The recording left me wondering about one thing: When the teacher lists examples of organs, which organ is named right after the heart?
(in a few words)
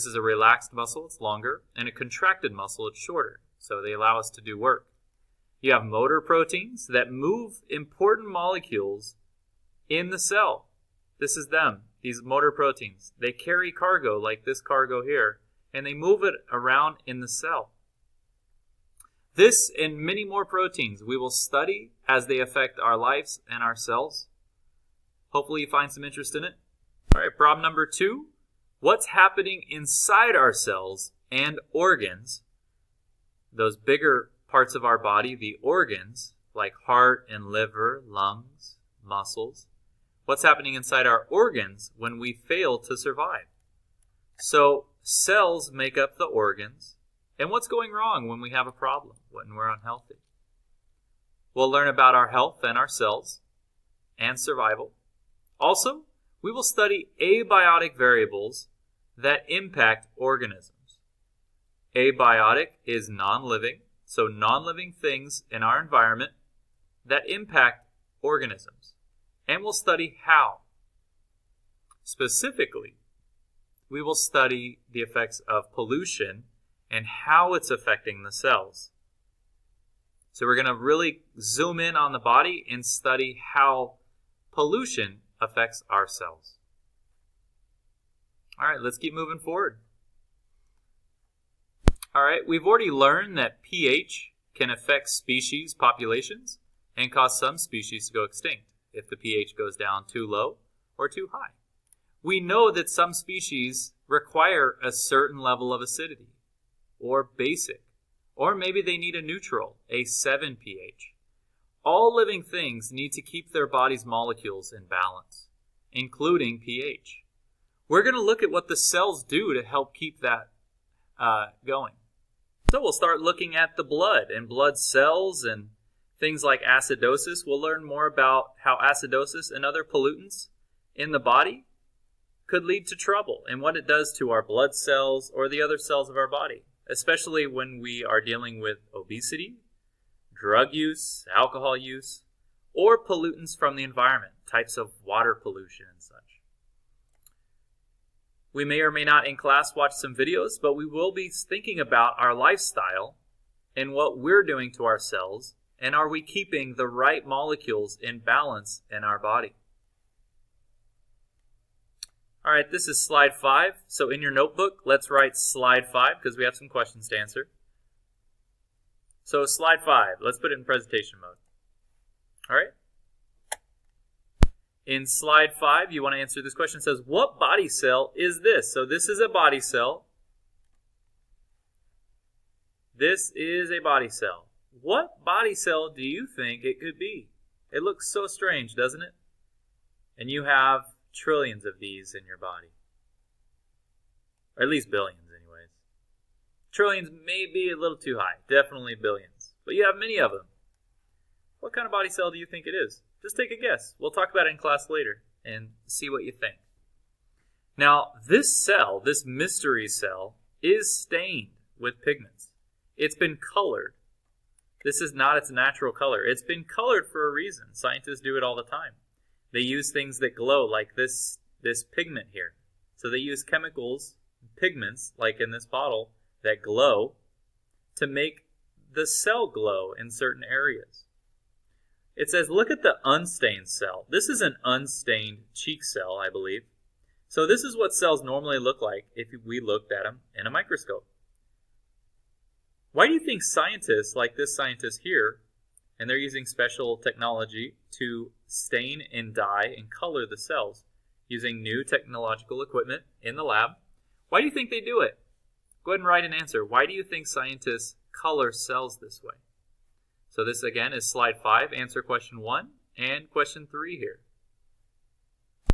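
liver.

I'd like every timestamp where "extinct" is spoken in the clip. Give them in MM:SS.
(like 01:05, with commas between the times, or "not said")
01:38.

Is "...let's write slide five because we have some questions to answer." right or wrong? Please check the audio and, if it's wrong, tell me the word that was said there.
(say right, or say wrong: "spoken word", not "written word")
right.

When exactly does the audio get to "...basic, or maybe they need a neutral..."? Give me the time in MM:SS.
01:47.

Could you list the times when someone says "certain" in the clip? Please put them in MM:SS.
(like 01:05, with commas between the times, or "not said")
01:44, 03:50.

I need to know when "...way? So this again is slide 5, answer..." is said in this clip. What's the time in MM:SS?
04:19.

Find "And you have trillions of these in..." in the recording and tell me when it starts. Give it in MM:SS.
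03:10.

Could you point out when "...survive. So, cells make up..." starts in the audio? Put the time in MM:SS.
00:42.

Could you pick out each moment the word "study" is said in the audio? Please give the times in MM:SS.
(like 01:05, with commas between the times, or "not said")
00:21, 00:56, 01:09, 01:14, 01:22.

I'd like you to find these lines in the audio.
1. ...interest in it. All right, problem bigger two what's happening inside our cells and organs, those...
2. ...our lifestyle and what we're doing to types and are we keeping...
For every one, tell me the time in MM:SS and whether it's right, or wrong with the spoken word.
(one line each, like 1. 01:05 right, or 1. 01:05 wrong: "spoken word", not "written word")
1. 00:26 wrong: "number", not "bigger"
2. 02:32 wrong: "ourselves", not "types".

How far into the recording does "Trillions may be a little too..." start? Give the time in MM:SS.
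03:16.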